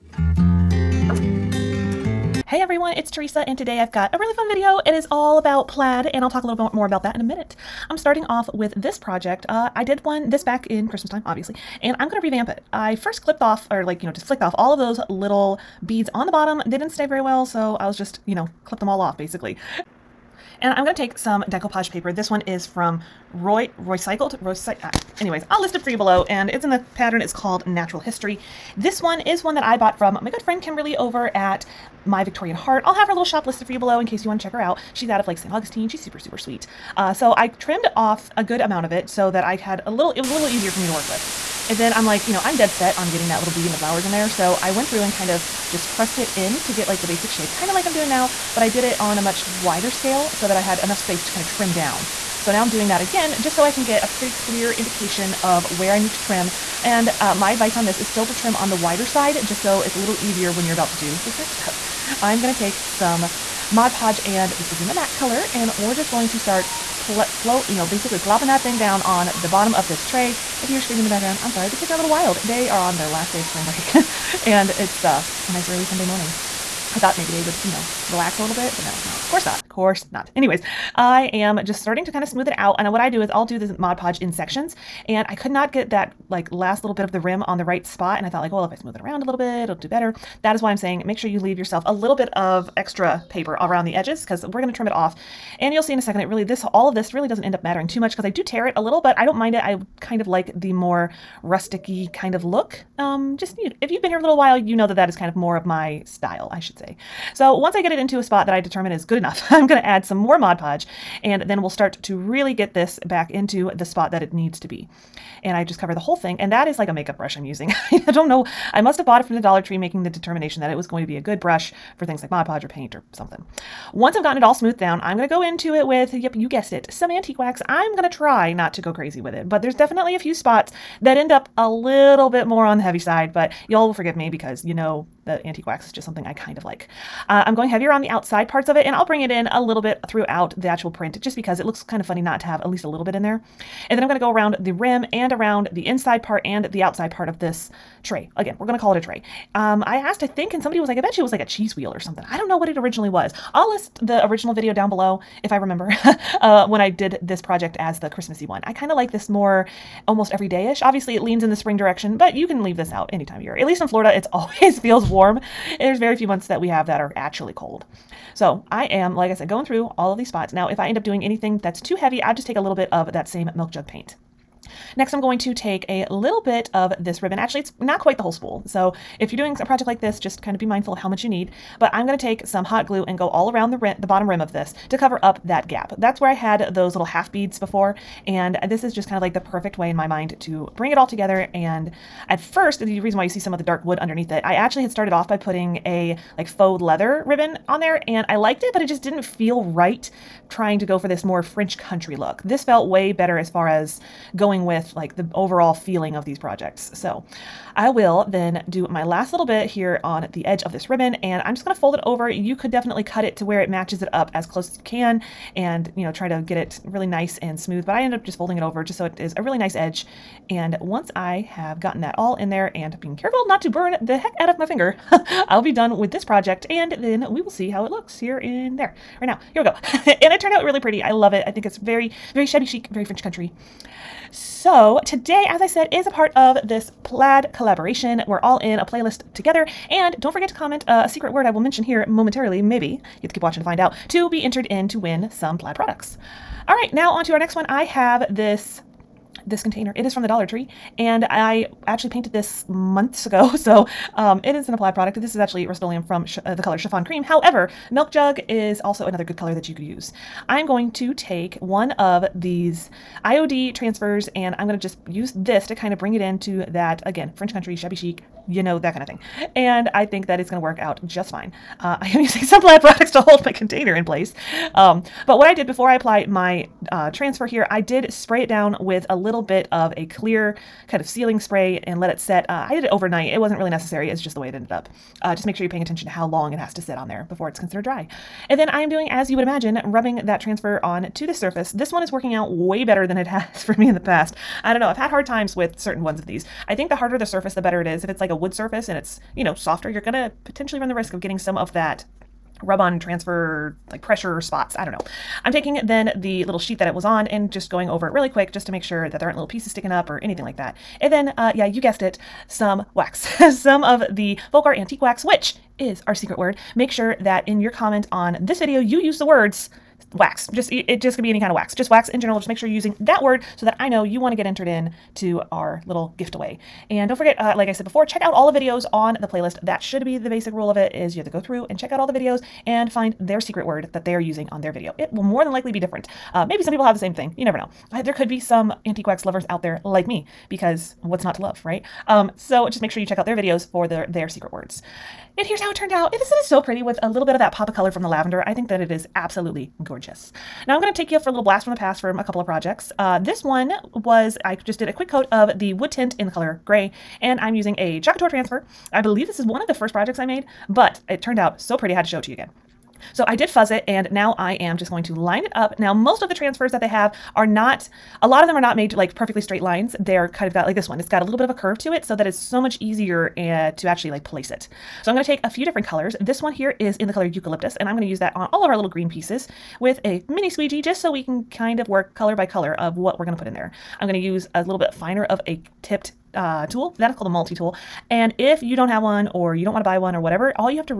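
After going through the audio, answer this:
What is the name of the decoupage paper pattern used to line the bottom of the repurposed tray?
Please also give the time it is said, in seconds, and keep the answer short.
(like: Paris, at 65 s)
Natural History, at 27 s.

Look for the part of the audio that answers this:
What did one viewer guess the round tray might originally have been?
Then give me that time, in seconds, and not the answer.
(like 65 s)
151 s.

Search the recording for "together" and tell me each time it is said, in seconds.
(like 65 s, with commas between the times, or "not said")
191 s, 239 s.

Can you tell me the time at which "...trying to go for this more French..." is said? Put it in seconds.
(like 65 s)
200 s.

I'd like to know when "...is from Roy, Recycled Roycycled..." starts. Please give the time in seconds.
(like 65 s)
22 s.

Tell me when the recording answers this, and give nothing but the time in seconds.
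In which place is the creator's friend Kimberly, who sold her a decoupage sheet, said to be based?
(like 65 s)
35 s.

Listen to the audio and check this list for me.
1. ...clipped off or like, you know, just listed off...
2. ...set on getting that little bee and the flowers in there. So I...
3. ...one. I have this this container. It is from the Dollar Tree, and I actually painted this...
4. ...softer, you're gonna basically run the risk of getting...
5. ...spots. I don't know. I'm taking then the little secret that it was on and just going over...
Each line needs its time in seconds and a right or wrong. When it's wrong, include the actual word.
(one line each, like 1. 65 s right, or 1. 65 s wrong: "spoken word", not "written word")
1. 13 s wrong: "flicked", not "listed"
2. 42 s right
3. 247 s right
4. 299 s wrong: "potentially", not "basically"
5. 304 s wrong: "sheet", not "secret".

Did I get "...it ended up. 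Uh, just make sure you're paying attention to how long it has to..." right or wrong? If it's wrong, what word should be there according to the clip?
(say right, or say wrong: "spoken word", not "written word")
right.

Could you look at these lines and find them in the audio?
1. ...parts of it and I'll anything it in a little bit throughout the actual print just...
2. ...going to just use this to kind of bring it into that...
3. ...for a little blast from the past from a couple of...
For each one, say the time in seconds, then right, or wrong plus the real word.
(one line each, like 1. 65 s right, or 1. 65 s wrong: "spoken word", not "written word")
1. 138 s wrong: "bring", not "anything"
2. 264 s right
3. 351 s right.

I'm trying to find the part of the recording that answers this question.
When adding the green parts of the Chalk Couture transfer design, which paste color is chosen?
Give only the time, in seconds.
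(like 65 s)
377 s.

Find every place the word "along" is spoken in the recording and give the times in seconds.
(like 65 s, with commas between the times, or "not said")
not said.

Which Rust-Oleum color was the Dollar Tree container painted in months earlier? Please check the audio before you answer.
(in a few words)
Chiffon Cream.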